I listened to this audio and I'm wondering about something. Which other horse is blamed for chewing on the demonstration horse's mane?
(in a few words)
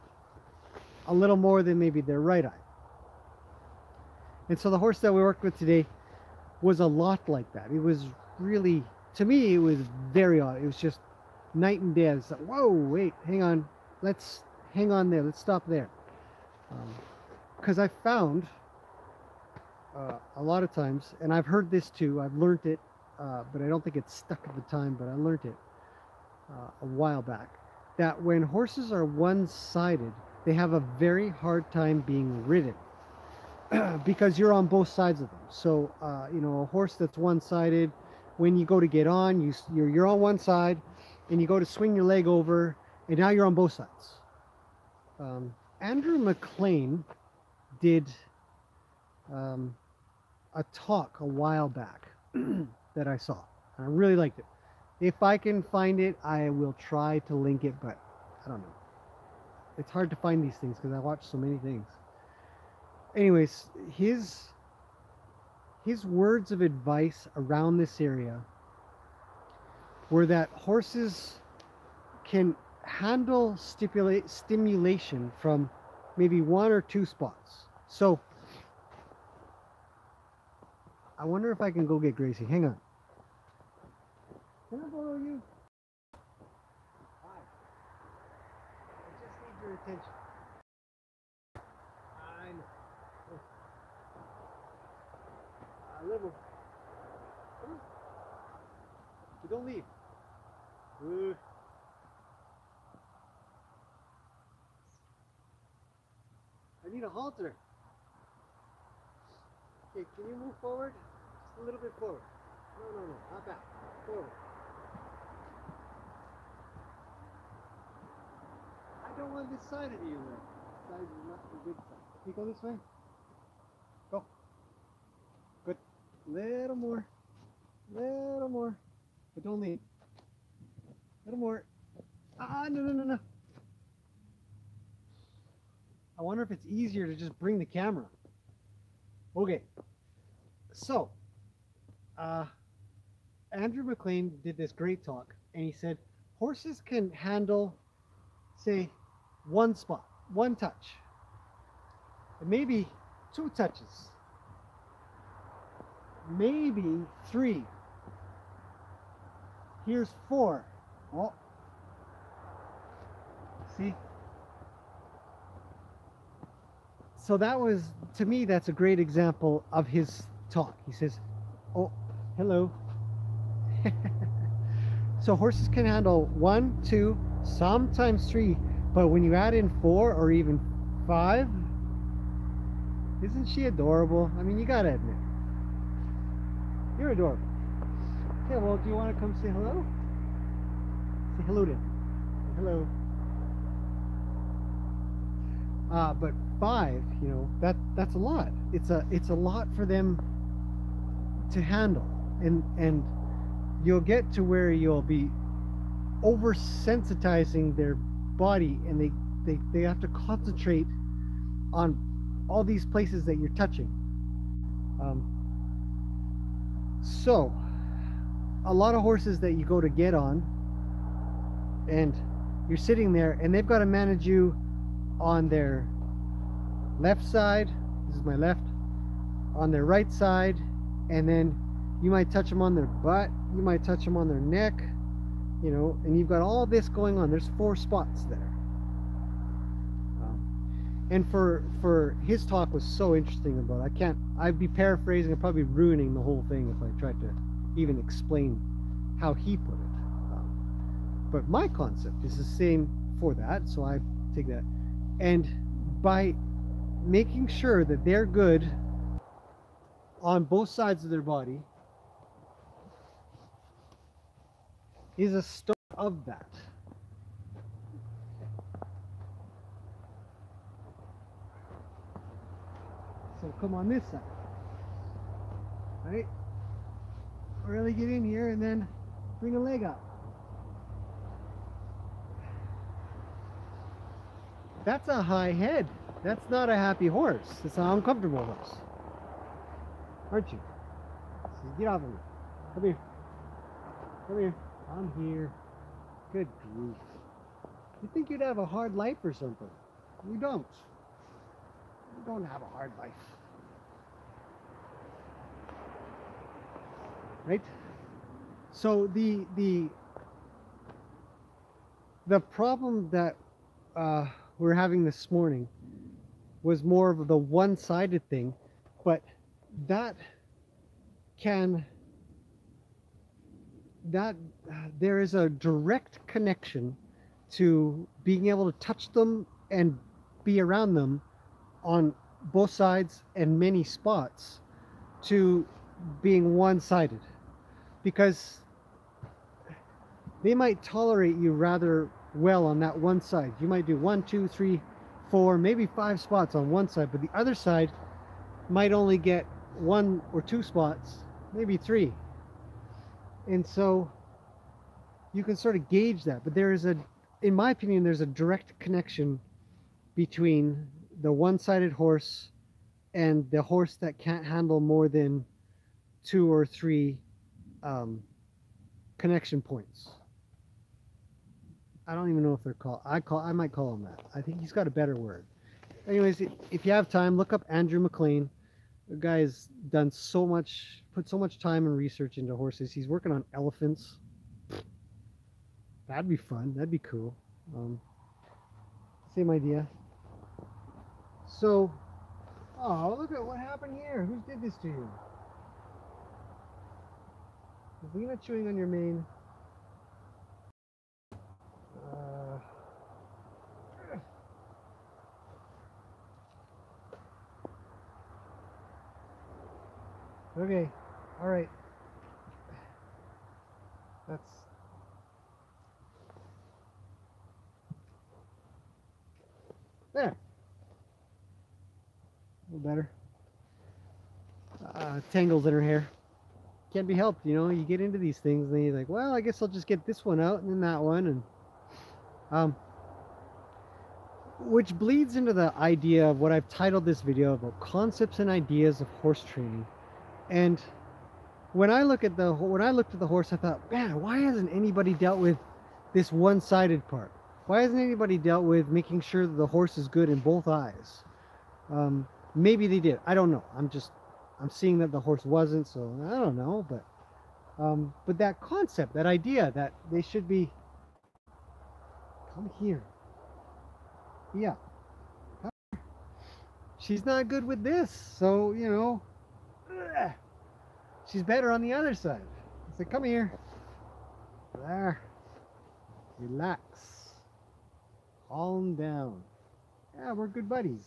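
Lena.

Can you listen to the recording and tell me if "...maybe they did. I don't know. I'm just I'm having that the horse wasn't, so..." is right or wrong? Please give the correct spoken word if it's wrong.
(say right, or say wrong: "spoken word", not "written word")
wrong: "seeing", not "having".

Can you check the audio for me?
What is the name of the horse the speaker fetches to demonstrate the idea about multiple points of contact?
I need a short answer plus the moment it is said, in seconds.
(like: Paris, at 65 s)
Gracie, at 82 s.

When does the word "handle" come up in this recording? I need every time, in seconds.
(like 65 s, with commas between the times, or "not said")
72 s, 147 s, 175 s, 201 s, 364 s.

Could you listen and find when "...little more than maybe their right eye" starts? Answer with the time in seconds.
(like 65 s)
1 s.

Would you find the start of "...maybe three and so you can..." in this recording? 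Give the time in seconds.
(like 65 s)
351 s.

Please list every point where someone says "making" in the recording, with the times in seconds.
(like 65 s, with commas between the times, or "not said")
257 s, 448 s.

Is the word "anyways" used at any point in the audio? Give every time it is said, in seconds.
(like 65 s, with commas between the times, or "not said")
63 s, 376 s.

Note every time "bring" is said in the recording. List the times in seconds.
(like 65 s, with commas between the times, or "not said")
137 s, 279 s.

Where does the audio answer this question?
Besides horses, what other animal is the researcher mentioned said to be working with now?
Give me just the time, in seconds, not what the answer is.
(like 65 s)
383 s.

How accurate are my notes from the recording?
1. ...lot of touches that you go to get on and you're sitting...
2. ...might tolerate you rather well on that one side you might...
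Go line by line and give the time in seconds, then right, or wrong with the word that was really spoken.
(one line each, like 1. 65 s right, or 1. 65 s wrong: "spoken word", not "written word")
1. 218 s wrong: "horses", not "touches"
2. 340 s right.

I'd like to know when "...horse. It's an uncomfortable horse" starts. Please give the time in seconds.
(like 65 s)
287 s.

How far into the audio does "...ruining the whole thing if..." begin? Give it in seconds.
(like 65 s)
245 s.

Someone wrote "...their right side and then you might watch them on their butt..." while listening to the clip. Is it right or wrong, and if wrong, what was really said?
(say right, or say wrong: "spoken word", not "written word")
wrong: "touch", not "watch".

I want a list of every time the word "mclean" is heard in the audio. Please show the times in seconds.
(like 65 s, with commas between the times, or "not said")
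46 s, 143 s, 377 s.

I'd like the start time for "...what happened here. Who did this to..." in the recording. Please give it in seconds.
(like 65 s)
393 s.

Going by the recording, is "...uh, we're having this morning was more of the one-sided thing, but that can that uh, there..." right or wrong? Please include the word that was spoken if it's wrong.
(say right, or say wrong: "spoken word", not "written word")
right.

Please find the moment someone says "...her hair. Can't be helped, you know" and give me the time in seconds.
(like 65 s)
425 s.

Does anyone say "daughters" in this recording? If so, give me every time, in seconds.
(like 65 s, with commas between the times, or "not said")
not said.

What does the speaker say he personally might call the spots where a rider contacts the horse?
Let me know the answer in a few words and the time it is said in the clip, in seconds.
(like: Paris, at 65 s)
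connection points, at 369 s.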